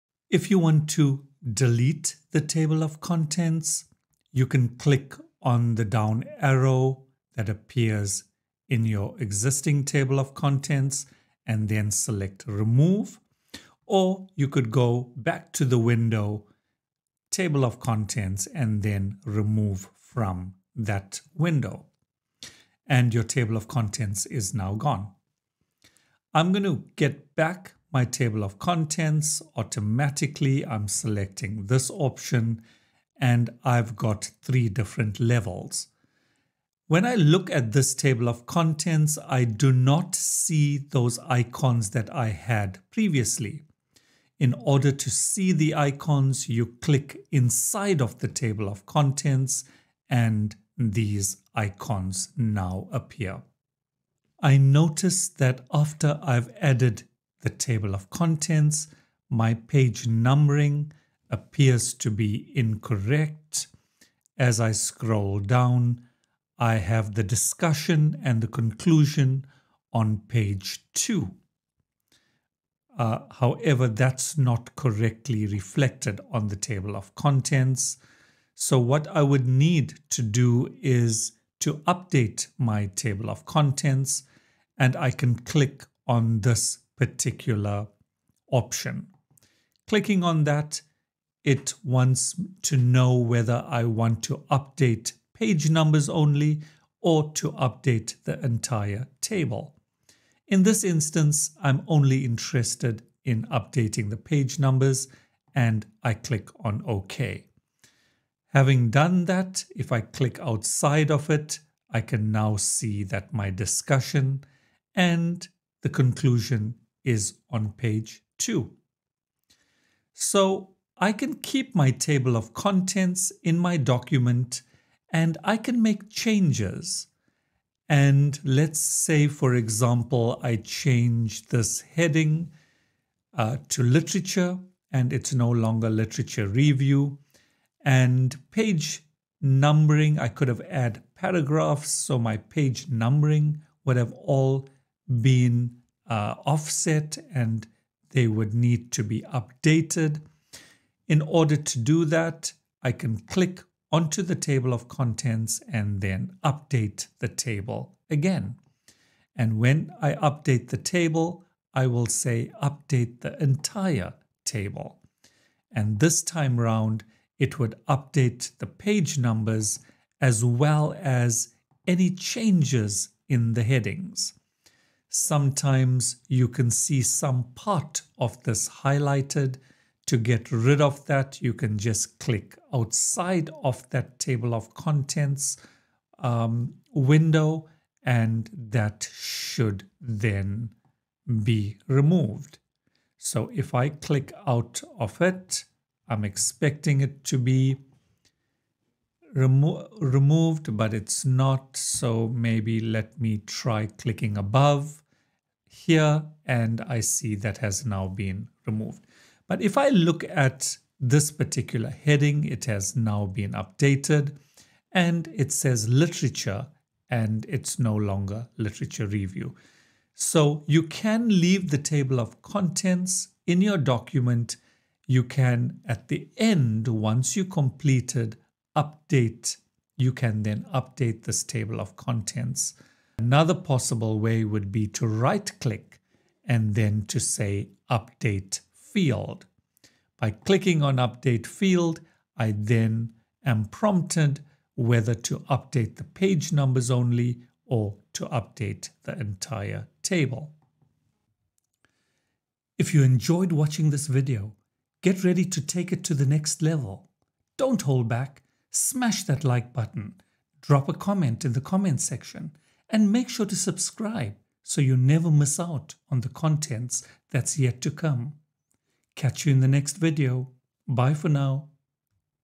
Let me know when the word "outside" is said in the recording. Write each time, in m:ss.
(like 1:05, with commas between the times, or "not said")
1:50, 3:02.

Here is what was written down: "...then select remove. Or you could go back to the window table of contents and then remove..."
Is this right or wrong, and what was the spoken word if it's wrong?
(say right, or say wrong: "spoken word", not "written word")
right.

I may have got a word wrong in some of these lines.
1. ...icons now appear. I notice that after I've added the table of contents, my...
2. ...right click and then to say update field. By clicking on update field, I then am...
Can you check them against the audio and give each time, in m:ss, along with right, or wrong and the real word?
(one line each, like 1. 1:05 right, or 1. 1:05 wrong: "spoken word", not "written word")
1. 0:51 right
2. 3:55 right.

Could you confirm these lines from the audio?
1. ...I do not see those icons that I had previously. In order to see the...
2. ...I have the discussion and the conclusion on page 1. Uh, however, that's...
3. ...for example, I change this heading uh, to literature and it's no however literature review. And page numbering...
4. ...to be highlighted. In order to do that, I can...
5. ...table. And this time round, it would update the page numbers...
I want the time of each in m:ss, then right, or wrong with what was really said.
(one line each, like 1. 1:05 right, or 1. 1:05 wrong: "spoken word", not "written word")
1. 0:39 right
2. 1:06 wrong: "2", not "1"
3. 2:09 wrong: "longer", not "however"
4. 2:28 wrong: "updated", not "highlighted"
5. 2:44 right.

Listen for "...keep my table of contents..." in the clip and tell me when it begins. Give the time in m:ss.
2:01.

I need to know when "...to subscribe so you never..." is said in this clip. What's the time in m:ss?
4:23.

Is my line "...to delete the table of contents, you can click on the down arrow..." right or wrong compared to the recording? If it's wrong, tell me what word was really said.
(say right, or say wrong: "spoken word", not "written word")
right.